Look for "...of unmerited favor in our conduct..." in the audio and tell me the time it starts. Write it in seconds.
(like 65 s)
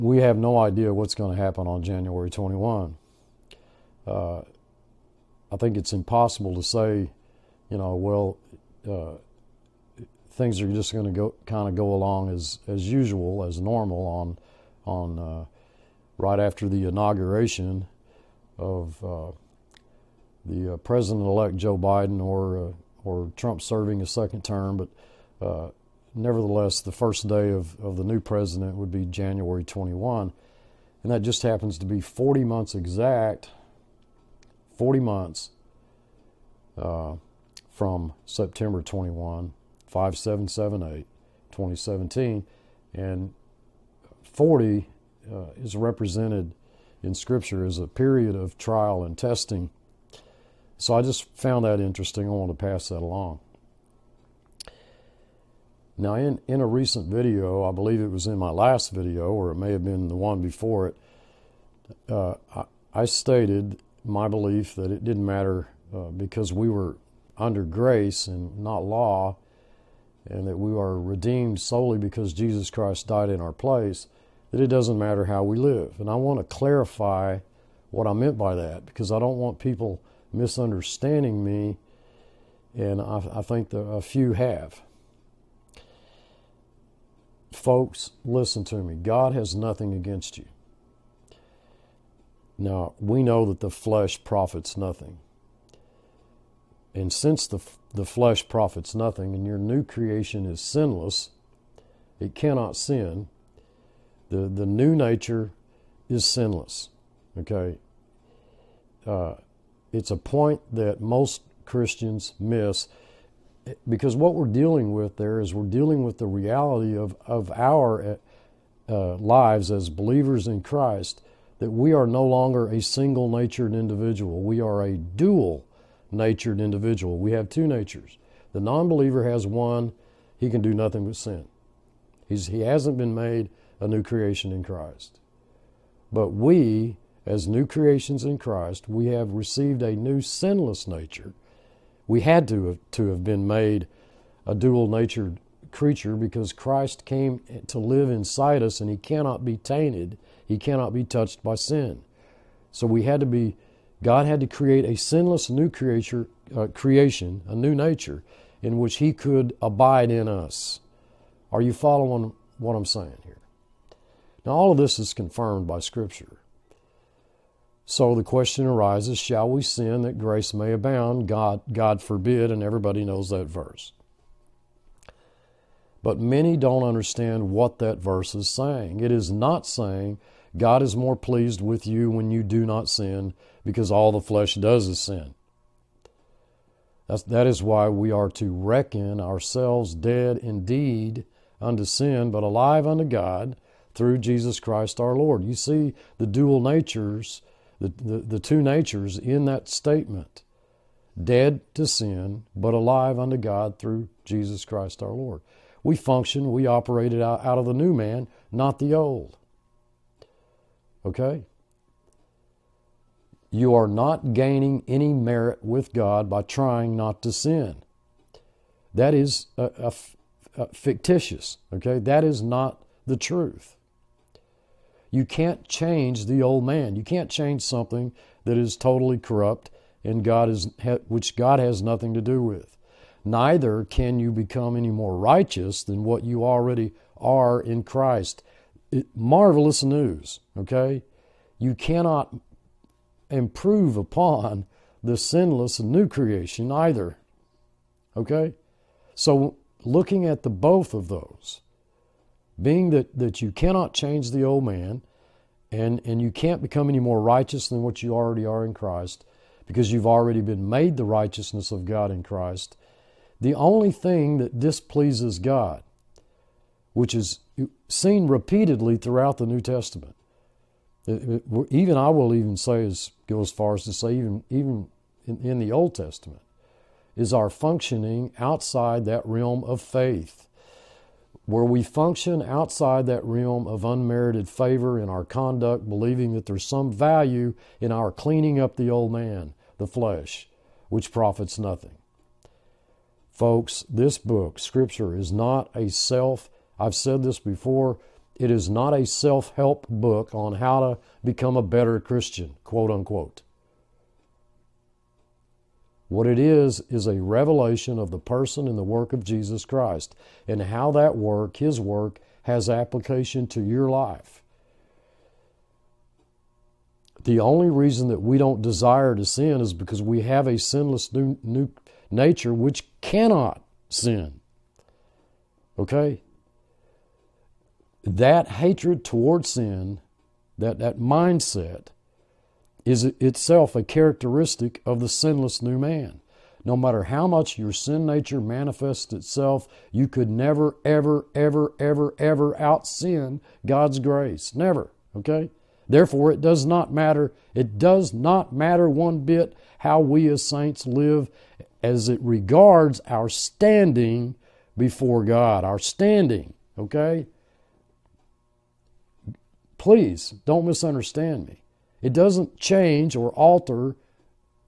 283 s.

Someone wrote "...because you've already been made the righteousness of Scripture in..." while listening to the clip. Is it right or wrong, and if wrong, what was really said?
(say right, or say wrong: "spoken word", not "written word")
wrong: "God", not "Scripture".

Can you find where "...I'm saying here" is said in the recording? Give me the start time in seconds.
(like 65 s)
162 s.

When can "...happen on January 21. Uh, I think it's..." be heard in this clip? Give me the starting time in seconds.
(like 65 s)
1 s.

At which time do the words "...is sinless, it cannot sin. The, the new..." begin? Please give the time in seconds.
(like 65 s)
100 s.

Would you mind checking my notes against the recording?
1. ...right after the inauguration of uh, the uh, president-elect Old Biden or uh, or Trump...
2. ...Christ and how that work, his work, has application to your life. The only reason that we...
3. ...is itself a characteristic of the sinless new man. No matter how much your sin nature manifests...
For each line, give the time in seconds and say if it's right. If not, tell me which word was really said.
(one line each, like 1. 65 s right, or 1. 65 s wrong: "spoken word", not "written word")
1. 16 s wrong: "Joe", not "Old"
2. 309 s right
3. 332 s right.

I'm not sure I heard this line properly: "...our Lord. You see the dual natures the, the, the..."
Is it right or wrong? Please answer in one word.
right.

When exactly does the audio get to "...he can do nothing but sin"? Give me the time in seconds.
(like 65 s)
130 s.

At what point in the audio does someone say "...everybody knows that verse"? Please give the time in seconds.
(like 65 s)
172 s.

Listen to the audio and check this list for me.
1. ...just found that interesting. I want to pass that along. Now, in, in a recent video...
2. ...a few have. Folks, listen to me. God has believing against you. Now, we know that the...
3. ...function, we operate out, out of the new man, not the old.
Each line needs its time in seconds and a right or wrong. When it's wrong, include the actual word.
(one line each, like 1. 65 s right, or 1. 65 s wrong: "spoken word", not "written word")
1. 51 s right
2. 83 s wrong: "nothing", not "believing"
3. 205 s right.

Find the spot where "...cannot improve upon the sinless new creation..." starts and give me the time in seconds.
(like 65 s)
241 s.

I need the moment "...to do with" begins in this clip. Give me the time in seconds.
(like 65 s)
232 s.